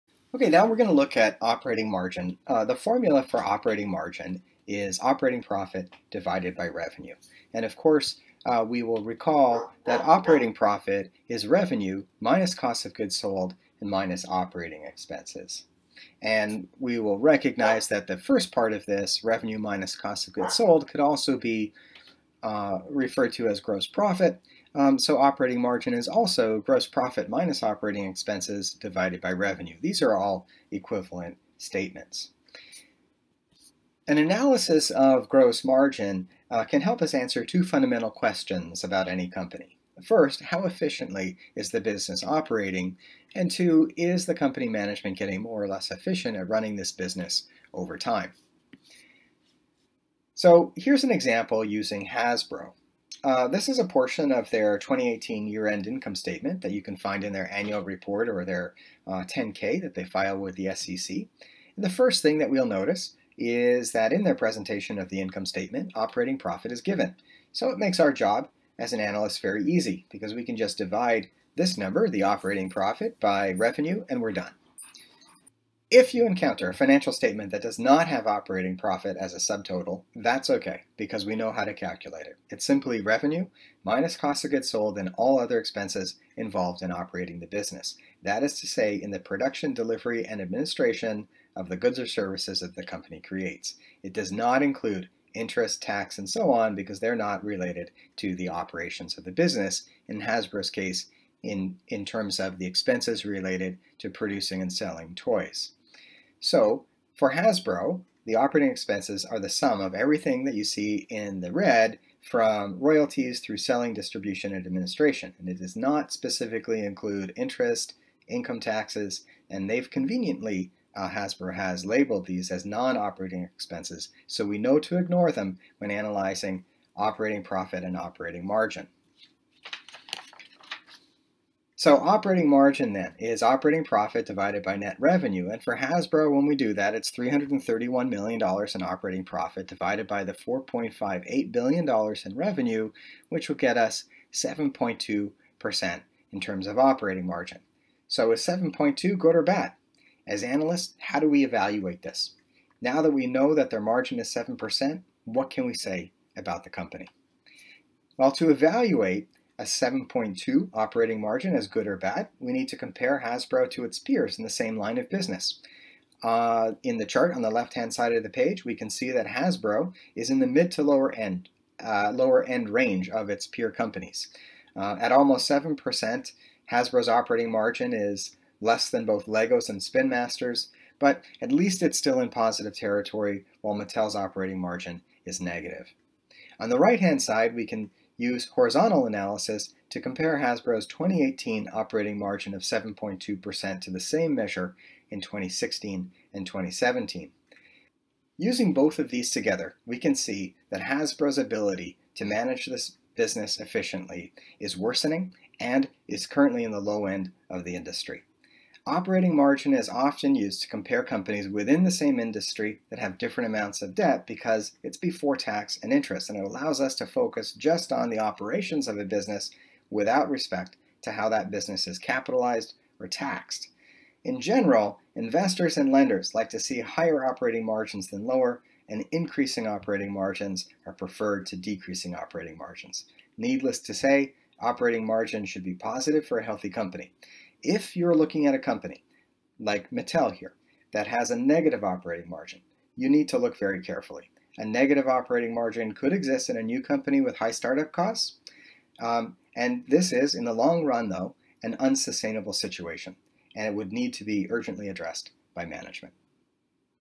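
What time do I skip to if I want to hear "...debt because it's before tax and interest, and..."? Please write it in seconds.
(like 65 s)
213 s.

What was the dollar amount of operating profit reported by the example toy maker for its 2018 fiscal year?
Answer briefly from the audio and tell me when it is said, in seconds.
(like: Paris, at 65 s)
$331 million, at 137 s.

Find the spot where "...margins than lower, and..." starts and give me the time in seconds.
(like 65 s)
227 s.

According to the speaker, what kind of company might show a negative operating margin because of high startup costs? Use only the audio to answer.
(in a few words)
A new company.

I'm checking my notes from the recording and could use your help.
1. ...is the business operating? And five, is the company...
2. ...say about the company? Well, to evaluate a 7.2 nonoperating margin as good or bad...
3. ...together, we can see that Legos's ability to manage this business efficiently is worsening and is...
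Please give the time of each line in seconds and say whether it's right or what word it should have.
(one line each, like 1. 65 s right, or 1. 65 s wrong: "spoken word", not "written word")
1. 41 s wrong: "two", not "five"
2. 155 s wrong: "operating", not "nonoperating"
3. 199 s wrong: "Hasbro", not "Legos".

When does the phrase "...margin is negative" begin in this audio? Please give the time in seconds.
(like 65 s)
184 s.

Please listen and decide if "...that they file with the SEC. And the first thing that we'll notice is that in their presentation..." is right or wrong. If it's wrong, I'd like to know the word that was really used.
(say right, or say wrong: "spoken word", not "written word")
right.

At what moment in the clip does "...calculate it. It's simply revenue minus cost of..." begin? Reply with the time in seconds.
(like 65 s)
81 s.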